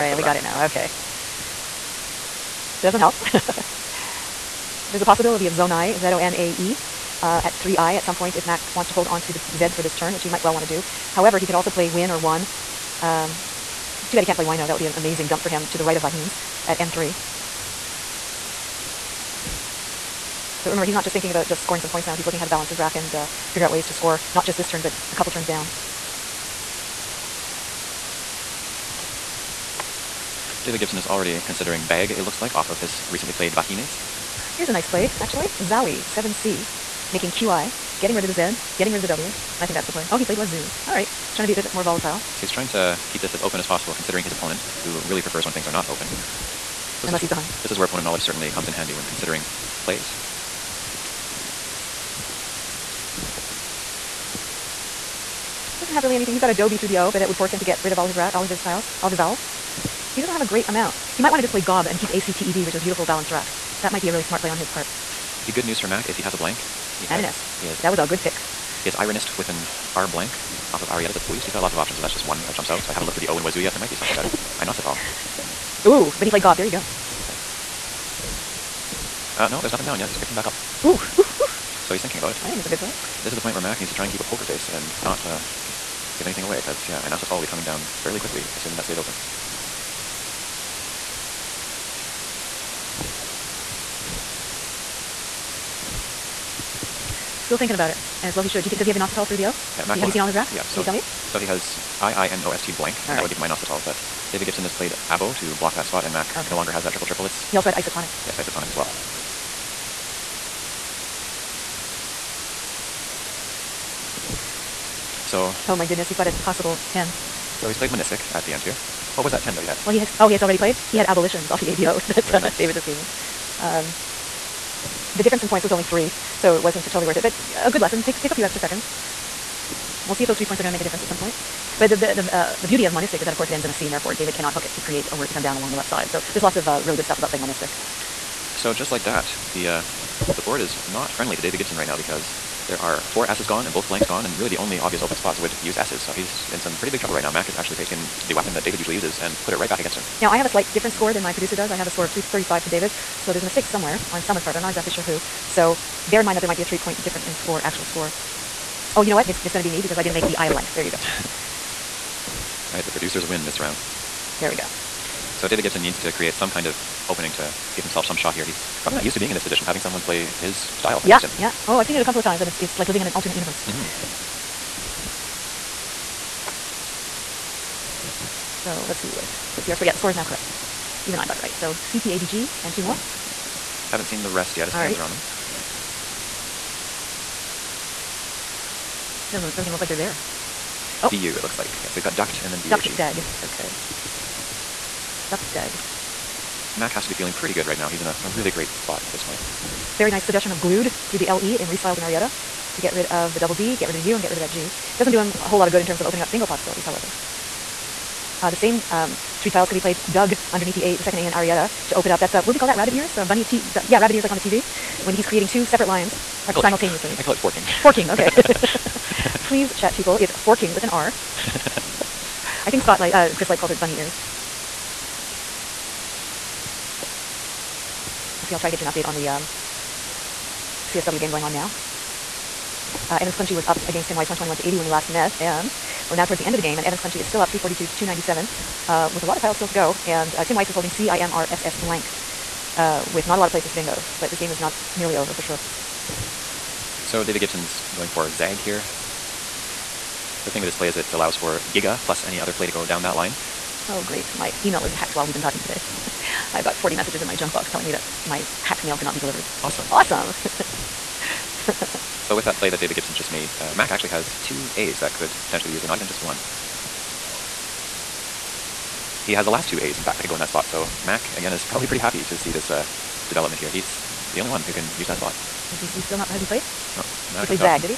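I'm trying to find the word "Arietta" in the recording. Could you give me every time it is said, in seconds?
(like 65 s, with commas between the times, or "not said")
70 s, 202 s, 211 s.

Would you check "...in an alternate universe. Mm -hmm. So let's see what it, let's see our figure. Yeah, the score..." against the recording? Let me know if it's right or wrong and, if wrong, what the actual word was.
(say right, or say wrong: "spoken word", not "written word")
wrong: "score", not "figure".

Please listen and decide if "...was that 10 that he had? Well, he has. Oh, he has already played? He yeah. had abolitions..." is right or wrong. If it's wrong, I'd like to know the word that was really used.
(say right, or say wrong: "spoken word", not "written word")
right.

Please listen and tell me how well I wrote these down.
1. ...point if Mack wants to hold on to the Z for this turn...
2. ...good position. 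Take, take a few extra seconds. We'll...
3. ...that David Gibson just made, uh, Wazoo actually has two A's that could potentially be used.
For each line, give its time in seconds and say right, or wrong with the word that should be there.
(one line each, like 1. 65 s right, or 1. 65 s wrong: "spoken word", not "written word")
1. 8 s right
2. 127 s wrong: "lesson", not "position"
3. 262 s wrong: "Mack", not "Wazoo".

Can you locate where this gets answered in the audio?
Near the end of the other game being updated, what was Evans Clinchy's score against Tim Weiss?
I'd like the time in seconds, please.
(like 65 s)
237 s.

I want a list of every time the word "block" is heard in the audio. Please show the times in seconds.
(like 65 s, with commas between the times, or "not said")
105 s.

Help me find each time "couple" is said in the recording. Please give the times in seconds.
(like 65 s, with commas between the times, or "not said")
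25 s, 172 s.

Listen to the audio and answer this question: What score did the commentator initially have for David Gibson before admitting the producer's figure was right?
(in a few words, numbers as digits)
335.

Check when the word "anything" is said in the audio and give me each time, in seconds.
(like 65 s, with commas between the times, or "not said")
56 s, 86 s.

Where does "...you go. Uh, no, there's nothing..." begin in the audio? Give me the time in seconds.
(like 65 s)
76 s.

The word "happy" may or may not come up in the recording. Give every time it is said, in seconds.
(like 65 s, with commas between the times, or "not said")
271 s.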